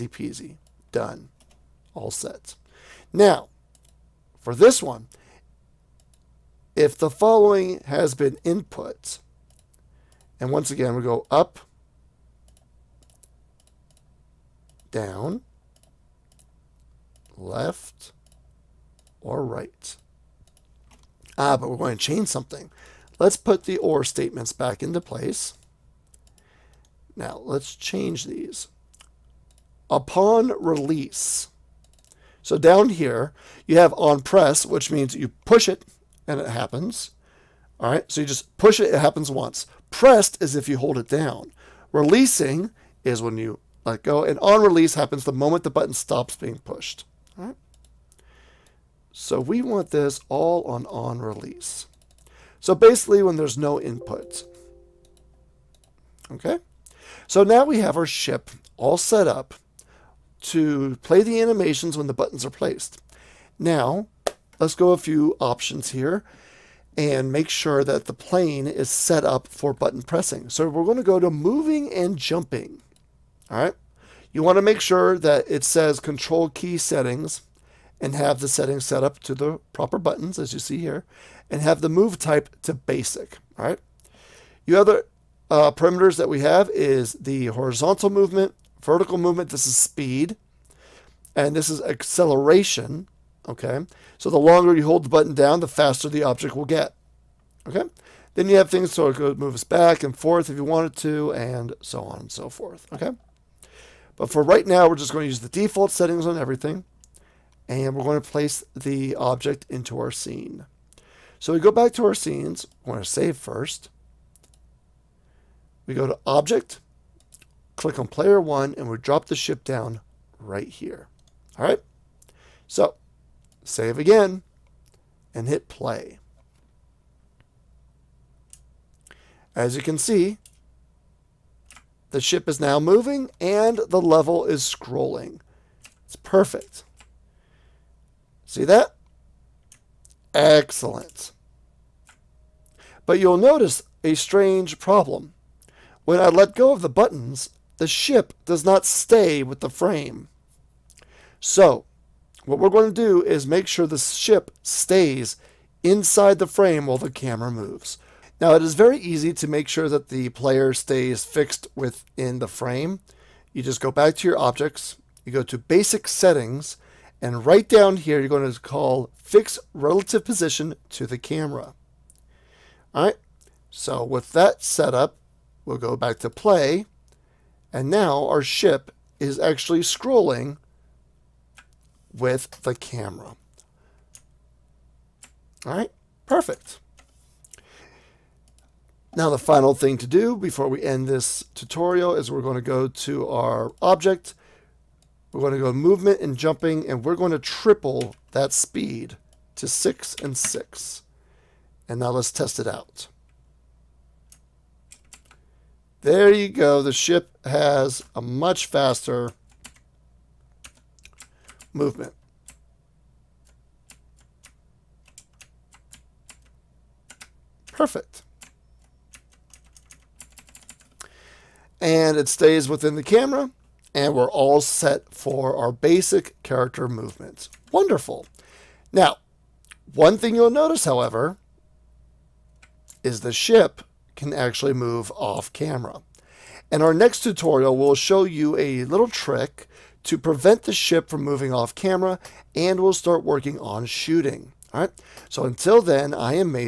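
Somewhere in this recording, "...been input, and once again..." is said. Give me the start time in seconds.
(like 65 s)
8 s.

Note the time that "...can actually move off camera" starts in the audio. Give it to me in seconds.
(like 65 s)
234 s.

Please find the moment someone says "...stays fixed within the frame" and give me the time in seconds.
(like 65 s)
160 s.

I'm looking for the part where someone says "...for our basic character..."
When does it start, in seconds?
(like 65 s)
225 s.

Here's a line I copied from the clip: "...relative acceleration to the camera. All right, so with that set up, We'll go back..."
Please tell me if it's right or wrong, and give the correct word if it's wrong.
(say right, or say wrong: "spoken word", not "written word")
wrong: "position", not "acceleration".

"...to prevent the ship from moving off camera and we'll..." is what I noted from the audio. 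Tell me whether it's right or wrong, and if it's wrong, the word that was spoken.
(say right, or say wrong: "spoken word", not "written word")
right.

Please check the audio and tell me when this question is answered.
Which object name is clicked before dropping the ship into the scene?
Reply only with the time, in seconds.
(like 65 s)
118 s.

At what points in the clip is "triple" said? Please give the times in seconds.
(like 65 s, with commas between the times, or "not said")
197 s.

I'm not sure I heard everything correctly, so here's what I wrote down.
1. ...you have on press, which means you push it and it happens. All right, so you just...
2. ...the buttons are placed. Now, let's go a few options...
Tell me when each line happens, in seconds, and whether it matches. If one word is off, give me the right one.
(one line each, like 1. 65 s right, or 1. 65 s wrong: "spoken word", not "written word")
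1. 33 s right
2. 62 s right.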